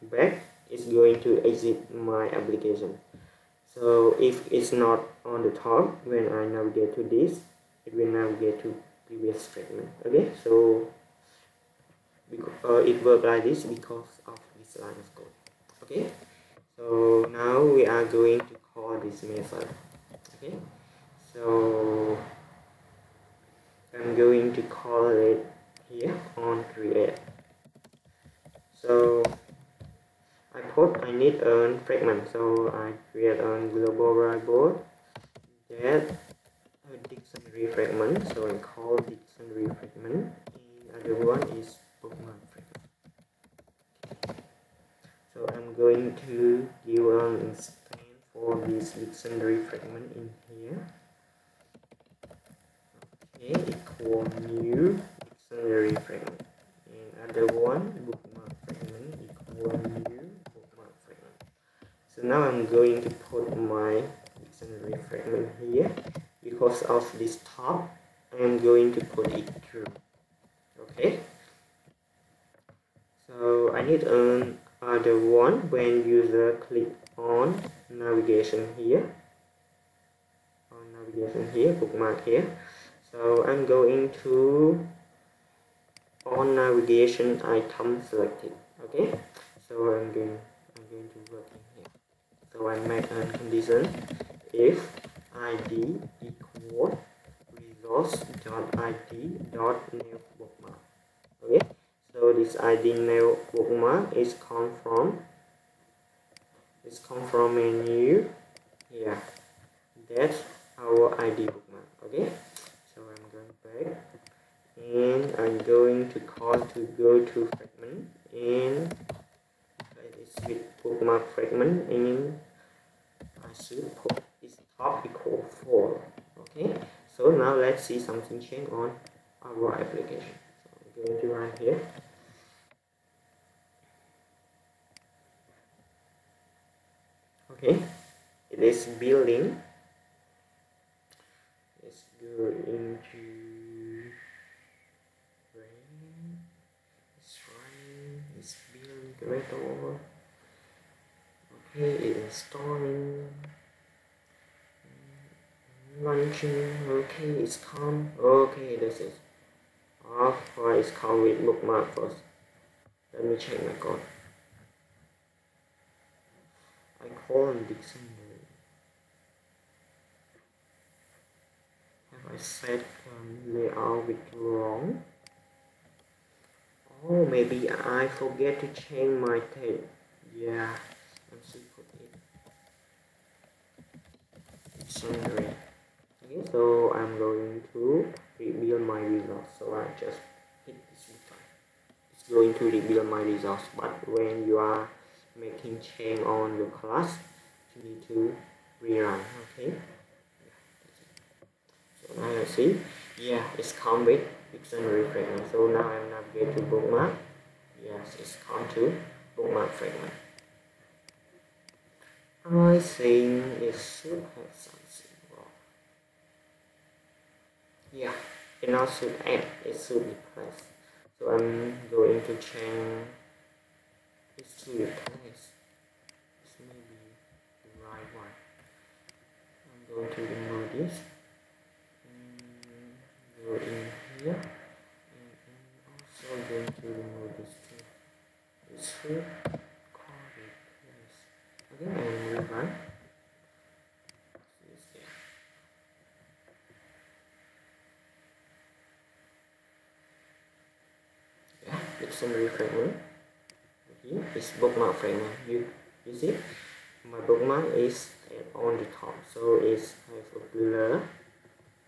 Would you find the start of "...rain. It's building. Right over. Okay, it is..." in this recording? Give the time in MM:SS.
02:27.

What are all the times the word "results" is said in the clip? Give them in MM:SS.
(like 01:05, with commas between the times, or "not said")
03:08, 03:13.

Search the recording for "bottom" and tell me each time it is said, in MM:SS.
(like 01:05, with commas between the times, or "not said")
not said.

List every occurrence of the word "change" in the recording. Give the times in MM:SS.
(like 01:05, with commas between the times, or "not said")
02:08, 02:58, 03:15, 03:42.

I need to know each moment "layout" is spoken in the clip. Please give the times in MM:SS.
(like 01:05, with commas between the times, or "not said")
02:53.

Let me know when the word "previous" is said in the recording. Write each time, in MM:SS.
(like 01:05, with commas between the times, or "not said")
00:09.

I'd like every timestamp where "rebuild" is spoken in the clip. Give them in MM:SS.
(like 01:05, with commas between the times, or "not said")
03:08, 03:12.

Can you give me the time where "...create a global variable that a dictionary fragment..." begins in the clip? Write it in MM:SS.
00:33.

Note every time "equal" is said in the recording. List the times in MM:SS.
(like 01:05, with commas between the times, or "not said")
00:53, 00:59, 01:36, 02:05.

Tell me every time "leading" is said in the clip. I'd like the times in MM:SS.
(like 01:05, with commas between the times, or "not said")
not said.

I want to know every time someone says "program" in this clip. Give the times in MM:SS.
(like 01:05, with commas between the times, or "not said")
not said.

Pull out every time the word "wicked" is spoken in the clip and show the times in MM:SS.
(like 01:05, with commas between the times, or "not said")
not said.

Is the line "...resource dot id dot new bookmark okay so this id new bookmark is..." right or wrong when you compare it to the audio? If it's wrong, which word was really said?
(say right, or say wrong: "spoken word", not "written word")
right.